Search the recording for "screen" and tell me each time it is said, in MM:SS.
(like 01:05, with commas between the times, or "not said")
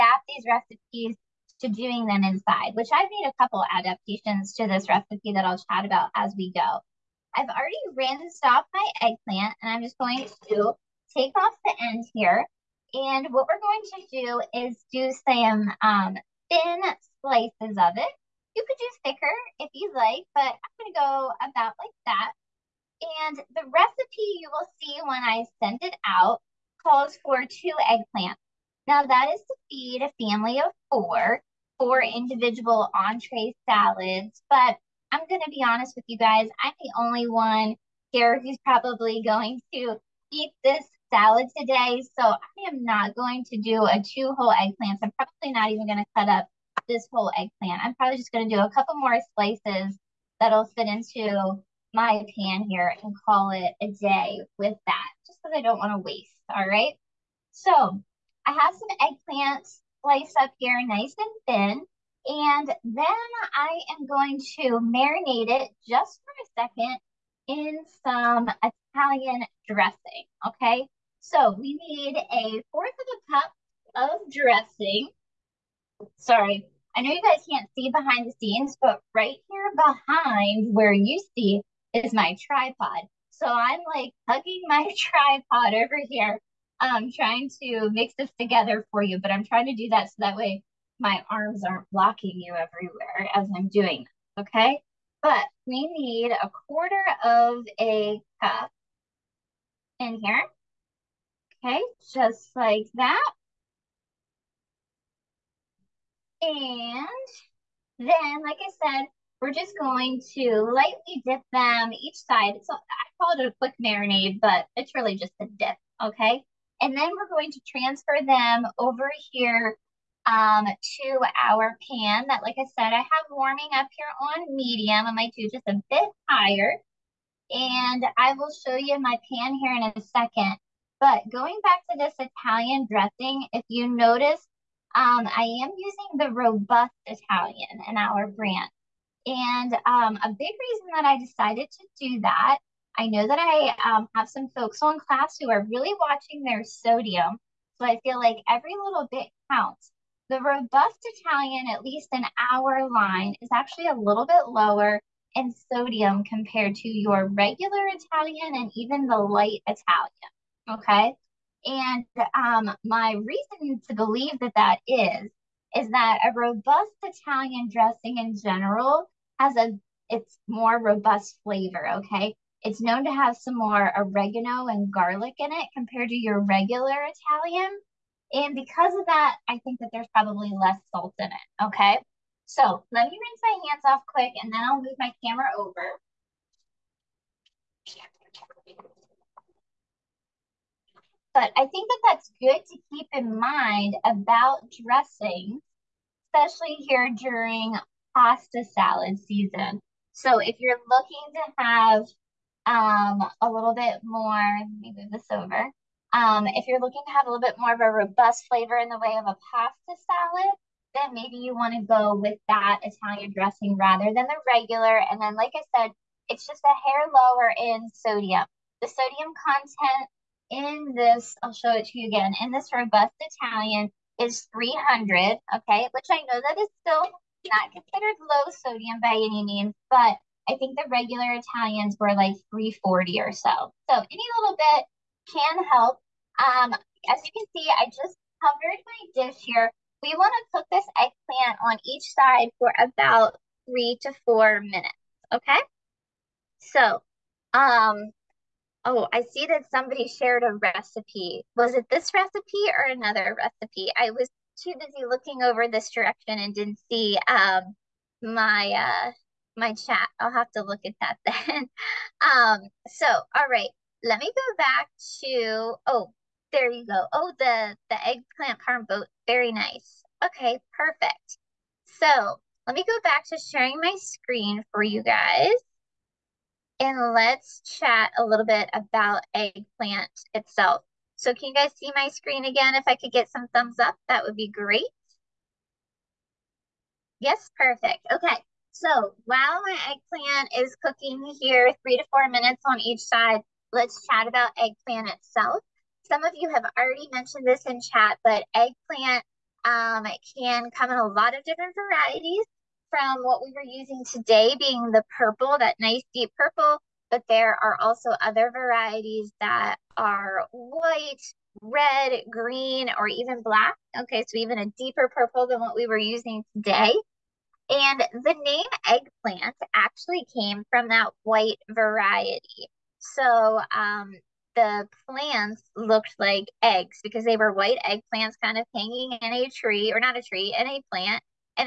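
04:33, 04:42.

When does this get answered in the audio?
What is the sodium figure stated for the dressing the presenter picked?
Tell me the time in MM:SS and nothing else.
03:44.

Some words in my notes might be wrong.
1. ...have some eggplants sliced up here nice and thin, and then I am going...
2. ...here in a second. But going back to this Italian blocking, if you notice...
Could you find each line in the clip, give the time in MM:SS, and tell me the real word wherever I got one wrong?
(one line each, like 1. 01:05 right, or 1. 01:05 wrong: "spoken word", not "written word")
1. 00:58 right
2. 02:09 wrong: "dressing", not "blocking".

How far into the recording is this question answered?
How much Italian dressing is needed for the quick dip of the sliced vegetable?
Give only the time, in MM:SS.
01:12.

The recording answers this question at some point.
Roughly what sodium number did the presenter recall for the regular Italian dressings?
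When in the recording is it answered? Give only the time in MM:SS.
03:52.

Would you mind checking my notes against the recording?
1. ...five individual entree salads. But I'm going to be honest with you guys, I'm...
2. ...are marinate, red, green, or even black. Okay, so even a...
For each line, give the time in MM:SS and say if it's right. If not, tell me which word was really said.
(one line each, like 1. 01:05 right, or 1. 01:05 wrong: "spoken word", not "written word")
1. 00:31 wrong: "four", not "five"
2. 05:09 wrong: "white", not "marinate".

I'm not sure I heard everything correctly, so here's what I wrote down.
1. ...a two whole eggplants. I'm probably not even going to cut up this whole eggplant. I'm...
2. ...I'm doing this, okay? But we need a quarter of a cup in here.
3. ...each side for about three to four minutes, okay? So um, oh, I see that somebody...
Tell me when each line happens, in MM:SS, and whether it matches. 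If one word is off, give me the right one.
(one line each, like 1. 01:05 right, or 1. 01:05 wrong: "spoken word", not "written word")
1. 00:43 right
2. 01:33 right
3. 04:01 right.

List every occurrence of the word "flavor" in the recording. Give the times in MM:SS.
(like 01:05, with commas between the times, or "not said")
02:51, 03:28.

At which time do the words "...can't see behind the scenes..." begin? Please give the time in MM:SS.
01:17.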